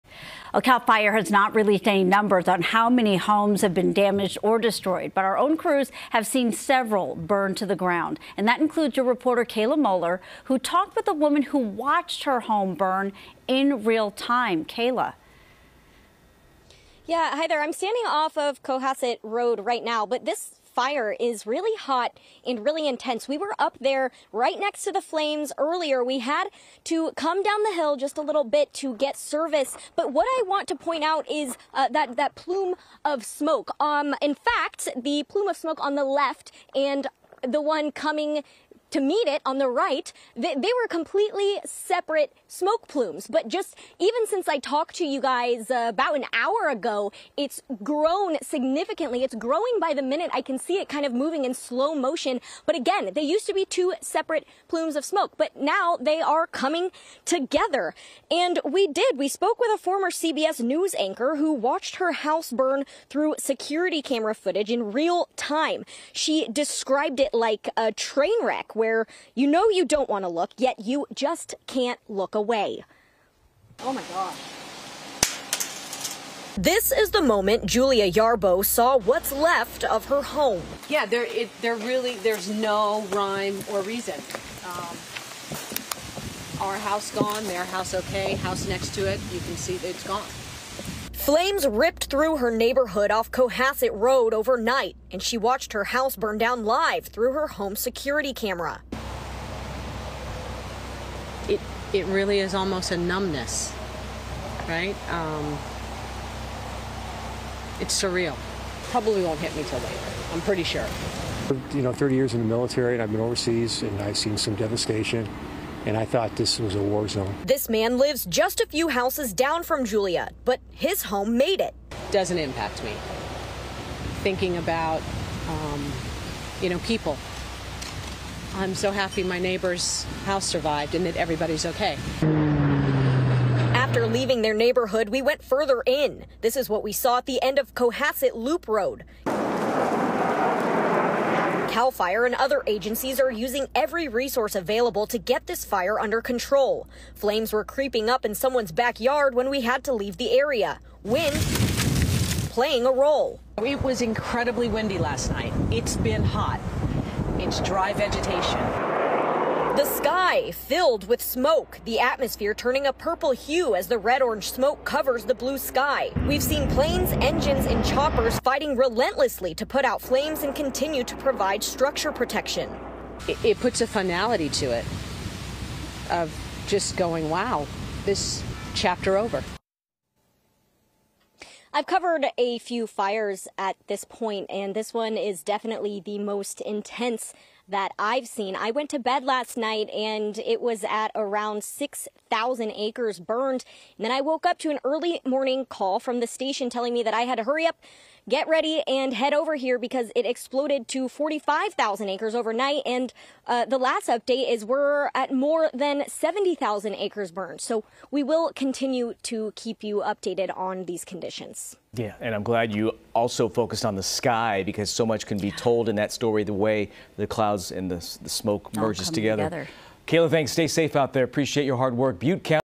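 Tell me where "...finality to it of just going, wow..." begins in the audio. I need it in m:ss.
2:53.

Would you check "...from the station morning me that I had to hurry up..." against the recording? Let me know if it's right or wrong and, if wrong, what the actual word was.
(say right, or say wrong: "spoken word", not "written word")
wrong: "telling", not "morning".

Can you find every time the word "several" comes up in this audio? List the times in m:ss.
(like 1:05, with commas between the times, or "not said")
0:06.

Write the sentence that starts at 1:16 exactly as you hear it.
This is the moment Julia Yarbo saw what's left of her home.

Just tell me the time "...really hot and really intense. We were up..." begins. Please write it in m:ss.
0:21.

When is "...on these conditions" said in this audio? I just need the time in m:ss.
3:30.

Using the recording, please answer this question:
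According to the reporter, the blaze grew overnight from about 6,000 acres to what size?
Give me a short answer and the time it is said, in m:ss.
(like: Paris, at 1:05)
45,000 acres, at 3:21.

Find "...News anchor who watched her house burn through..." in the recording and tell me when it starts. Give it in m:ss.
1:00.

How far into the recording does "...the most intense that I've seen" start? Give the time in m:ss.
3:06.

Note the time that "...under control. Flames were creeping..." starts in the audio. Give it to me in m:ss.
2:26.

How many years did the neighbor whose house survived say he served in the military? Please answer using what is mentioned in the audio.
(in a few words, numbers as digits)
30.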